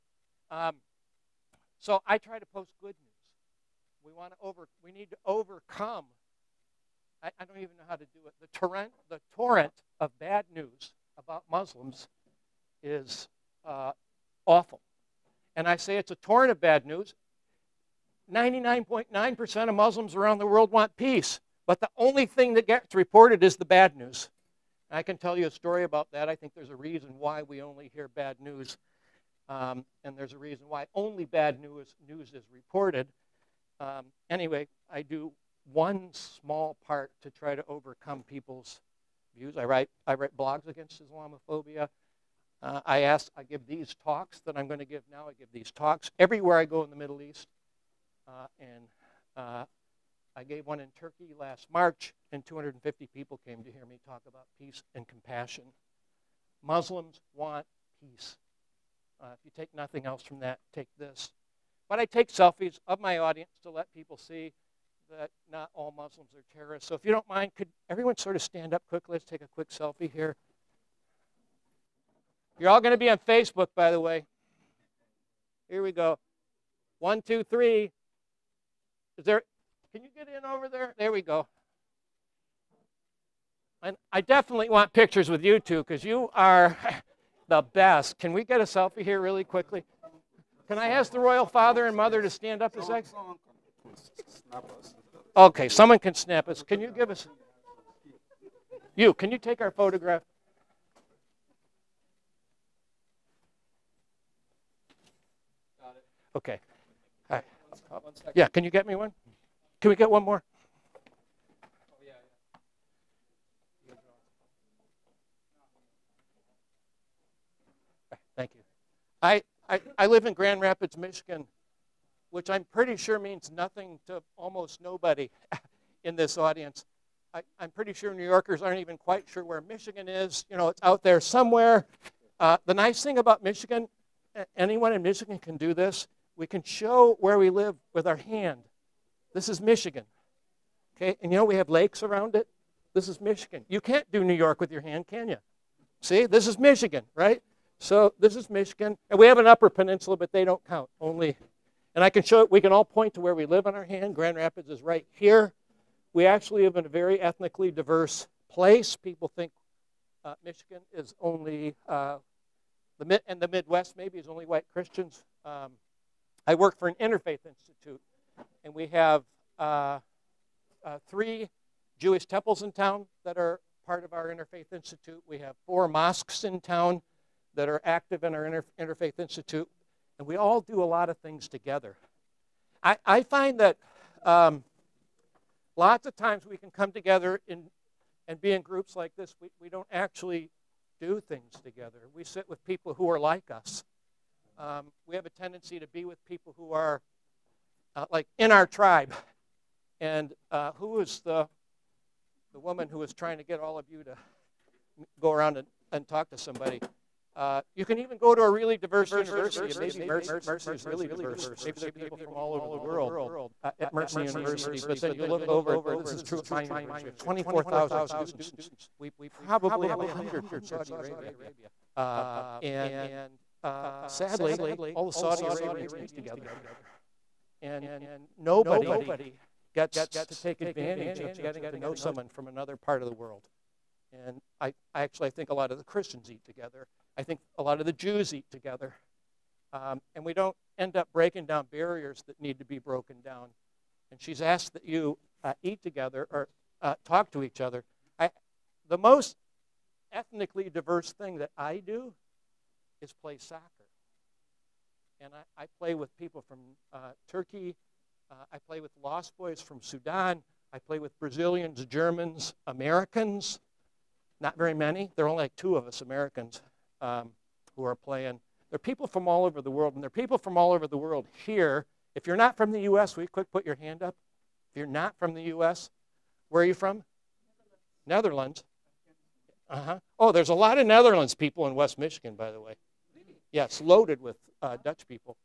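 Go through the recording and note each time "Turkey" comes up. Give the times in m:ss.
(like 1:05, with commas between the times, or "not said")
0:50, 4:17.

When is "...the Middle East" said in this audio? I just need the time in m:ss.
0:46.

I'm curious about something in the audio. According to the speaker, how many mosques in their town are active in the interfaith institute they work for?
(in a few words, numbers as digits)
4.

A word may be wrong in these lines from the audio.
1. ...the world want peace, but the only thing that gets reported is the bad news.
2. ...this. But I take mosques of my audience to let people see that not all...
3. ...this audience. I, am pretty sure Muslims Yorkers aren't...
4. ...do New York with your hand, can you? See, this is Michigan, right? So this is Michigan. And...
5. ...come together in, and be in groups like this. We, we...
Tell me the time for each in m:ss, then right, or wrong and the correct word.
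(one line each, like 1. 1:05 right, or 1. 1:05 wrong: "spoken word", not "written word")
1. 0:20 right
2. 1:00 wrong: "selfies", not "mosques"
3. 2:06 wrong: "New", not "Muslims"
4. 2:24 right
5. 3:06 right.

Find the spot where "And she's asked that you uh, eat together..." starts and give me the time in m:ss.
4:04.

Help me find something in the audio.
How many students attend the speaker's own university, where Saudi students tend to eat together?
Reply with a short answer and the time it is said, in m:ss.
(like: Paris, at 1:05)
24,000, at 3:37.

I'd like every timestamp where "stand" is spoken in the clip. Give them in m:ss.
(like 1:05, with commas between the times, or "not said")
1:08, 1:32.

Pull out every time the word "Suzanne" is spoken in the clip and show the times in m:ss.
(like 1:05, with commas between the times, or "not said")
not said.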